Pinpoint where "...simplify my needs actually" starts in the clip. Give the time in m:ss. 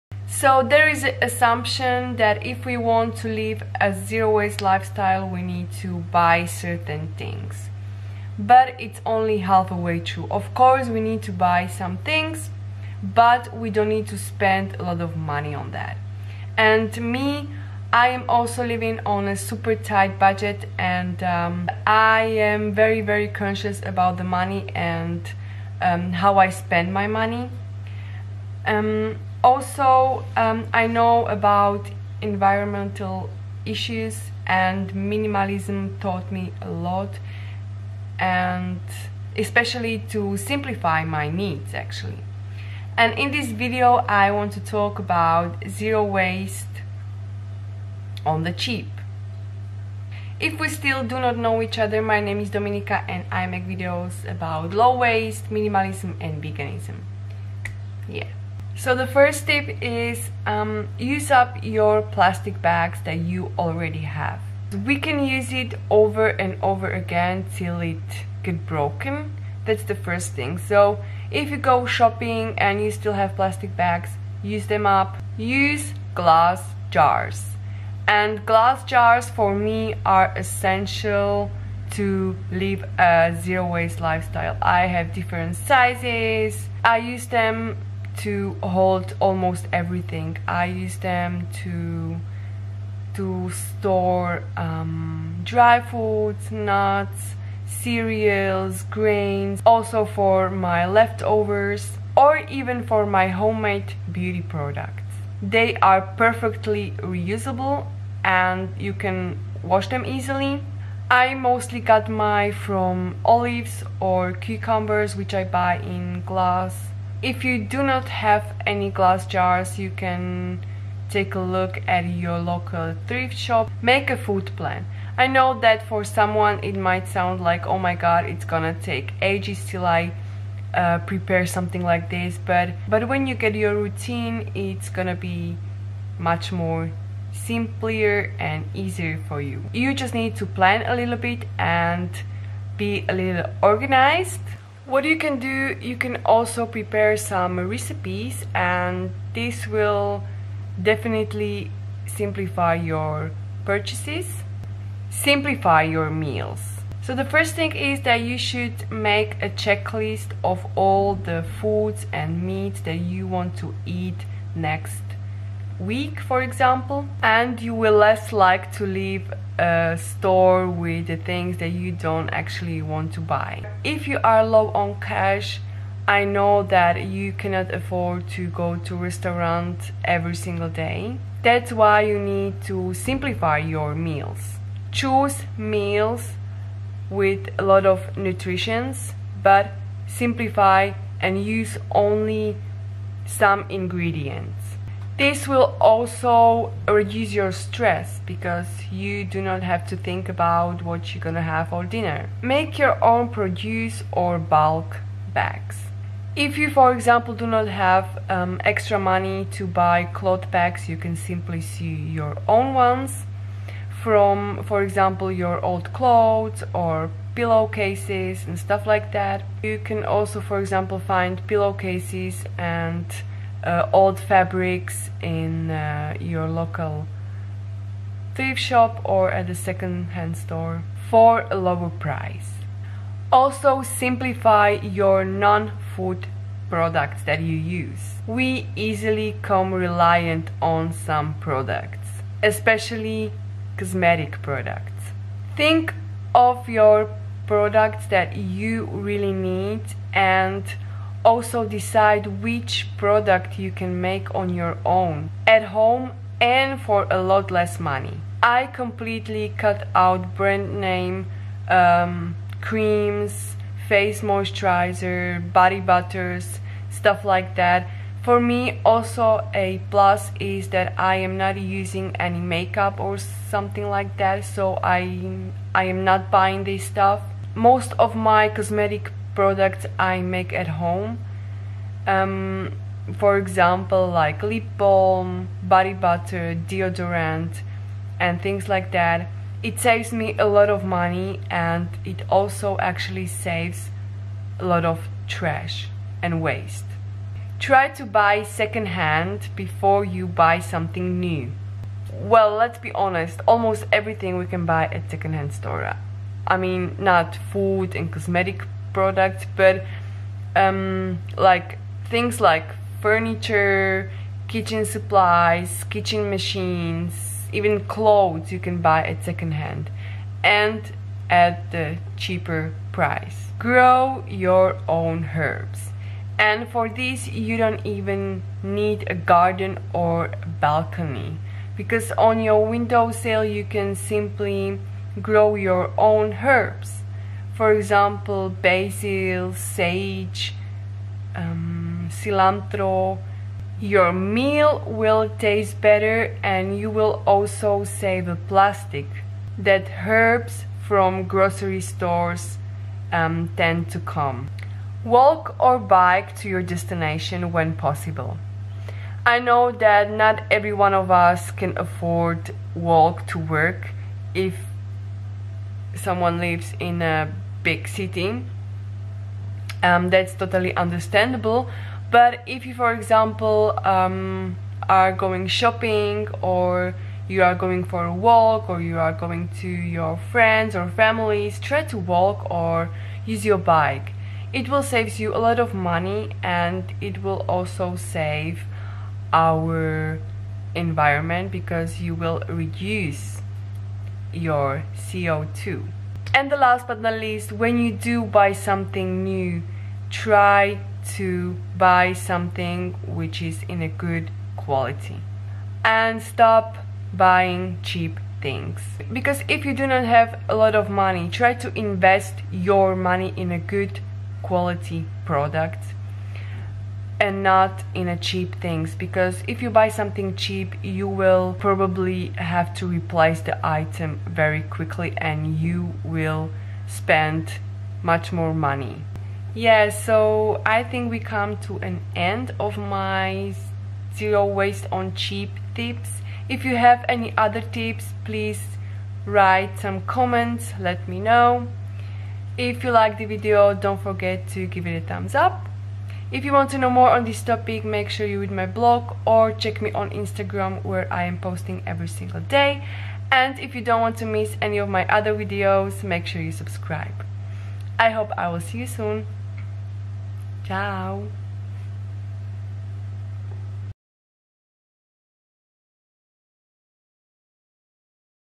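0:40.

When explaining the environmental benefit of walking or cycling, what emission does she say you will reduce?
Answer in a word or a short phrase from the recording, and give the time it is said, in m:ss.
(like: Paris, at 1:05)
CO2, at 6:34.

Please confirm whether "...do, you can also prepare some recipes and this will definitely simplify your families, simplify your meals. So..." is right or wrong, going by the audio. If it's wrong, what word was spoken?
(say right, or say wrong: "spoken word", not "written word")
wrong: "purchases", not "families".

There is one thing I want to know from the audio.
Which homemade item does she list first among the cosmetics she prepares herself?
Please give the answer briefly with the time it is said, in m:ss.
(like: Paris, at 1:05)
lip balm, at 4:44.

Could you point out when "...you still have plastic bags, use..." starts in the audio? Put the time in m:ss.
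1:12.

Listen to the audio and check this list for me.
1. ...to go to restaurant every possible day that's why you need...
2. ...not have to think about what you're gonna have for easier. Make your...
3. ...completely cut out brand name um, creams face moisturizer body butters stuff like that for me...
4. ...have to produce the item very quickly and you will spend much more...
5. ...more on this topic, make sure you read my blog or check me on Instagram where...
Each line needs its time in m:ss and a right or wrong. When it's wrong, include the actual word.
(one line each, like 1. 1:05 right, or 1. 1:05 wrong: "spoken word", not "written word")
1. 2:58 wrong: "single", not "possible"
2. 3:19 wrong: "dinner", not "easier"
3. 4:18 right
4. 7:02 wrong: "replace", not "produce"
5. 7:26 right.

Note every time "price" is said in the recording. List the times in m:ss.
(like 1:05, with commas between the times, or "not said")
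3:51, 5:22.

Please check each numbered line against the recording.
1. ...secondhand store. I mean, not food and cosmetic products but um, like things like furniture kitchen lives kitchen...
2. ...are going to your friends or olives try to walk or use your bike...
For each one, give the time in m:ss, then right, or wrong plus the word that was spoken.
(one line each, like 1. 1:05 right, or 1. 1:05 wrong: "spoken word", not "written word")
1. 5:05 wrong: "supplies", not "lives"
2. 6:18 wrong: "families", not "olives".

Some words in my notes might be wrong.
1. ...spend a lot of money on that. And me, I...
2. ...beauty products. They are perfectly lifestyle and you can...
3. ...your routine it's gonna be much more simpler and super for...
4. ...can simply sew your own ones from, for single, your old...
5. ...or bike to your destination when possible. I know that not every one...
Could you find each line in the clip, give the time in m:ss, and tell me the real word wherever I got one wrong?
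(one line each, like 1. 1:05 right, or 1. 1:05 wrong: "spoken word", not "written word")
1. 0:14 right
2. 1:44 wrong: "reusable", not "lifestyle"
3. 2:13 wrong: "easier", not "super"
4. 3:30 wrong: "example", not "single"
5. 5:55 right.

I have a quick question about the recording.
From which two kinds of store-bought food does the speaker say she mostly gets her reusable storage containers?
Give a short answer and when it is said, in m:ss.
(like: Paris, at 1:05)
olives or cucumbers, at 1:53.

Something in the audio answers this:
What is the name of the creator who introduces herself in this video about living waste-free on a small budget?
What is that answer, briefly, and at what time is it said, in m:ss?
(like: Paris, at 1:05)
Dominika, at 0:52.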